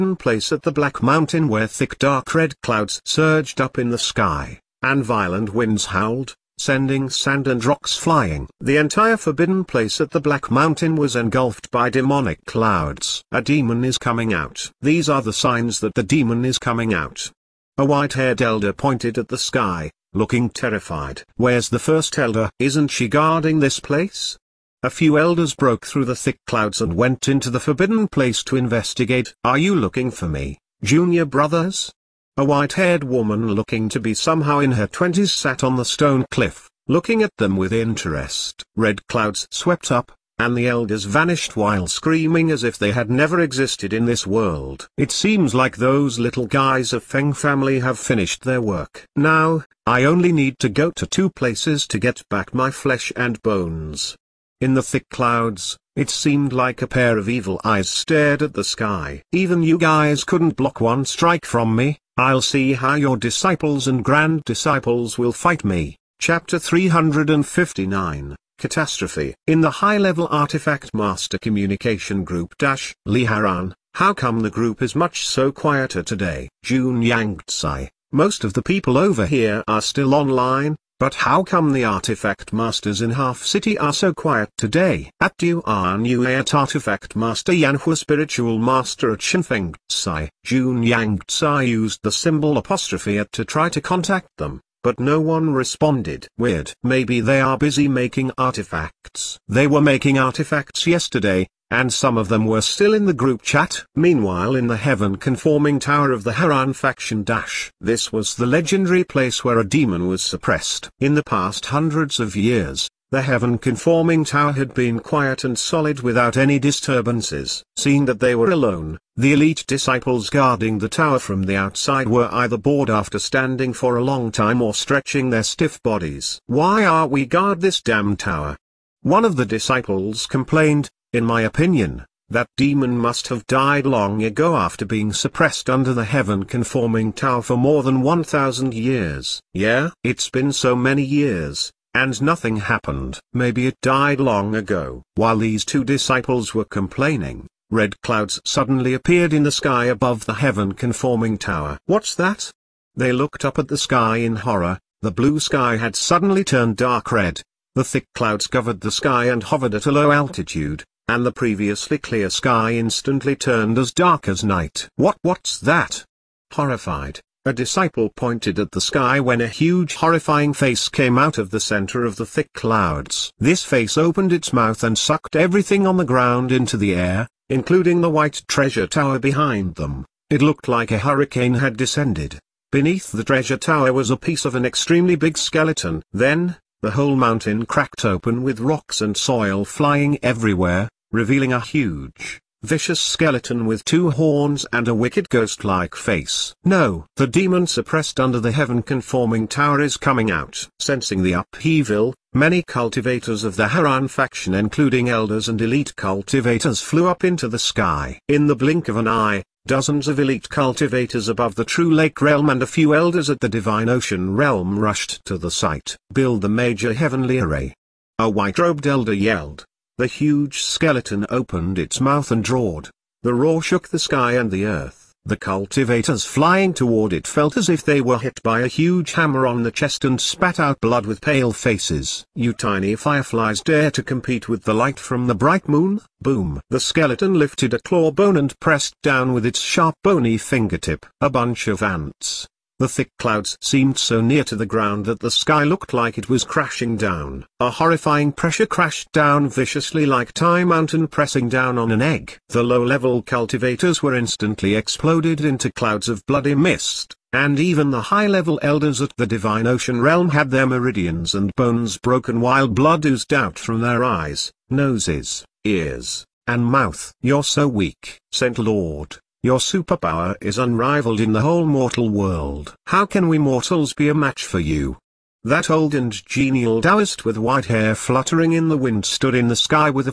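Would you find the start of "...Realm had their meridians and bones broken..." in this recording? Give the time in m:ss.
4:20.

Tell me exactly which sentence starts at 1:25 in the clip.
At you are new at artifact master Yanhua spiritual master at Shenfeng Tsai.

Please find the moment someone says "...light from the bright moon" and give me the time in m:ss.
3:54.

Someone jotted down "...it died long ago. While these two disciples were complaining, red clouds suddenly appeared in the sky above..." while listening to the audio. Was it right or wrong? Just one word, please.
right.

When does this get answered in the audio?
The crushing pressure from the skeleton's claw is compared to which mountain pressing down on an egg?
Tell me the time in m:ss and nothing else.
4:10.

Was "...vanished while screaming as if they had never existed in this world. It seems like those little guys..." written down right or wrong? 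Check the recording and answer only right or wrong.
right.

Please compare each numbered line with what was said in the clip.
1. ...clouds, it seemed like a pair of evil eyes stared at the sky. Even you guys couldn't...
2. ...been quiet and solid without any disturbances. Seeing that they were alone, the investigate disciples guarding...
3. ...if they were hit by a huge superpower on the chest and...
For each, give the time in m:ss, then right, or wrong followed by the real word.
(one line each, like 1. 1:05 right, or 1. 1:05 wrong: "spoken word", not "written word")
1. 0:55 right
2. 1:54 wrong: "elite", not "investigate"
3. 3:47 wrong: "hammer", not "superpower".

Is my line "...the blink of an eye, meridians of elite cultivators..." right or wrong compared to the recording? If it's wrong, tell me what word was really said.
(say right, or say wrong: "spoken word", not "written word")
wrong: "dozens", not "meridians".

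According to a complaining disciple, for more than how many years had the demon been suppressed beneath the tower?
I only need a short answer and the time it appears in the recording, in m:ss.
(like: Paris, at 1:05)
1,000, at 2:18.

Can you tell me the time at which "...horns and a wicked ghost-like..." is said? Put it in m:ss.
3:14.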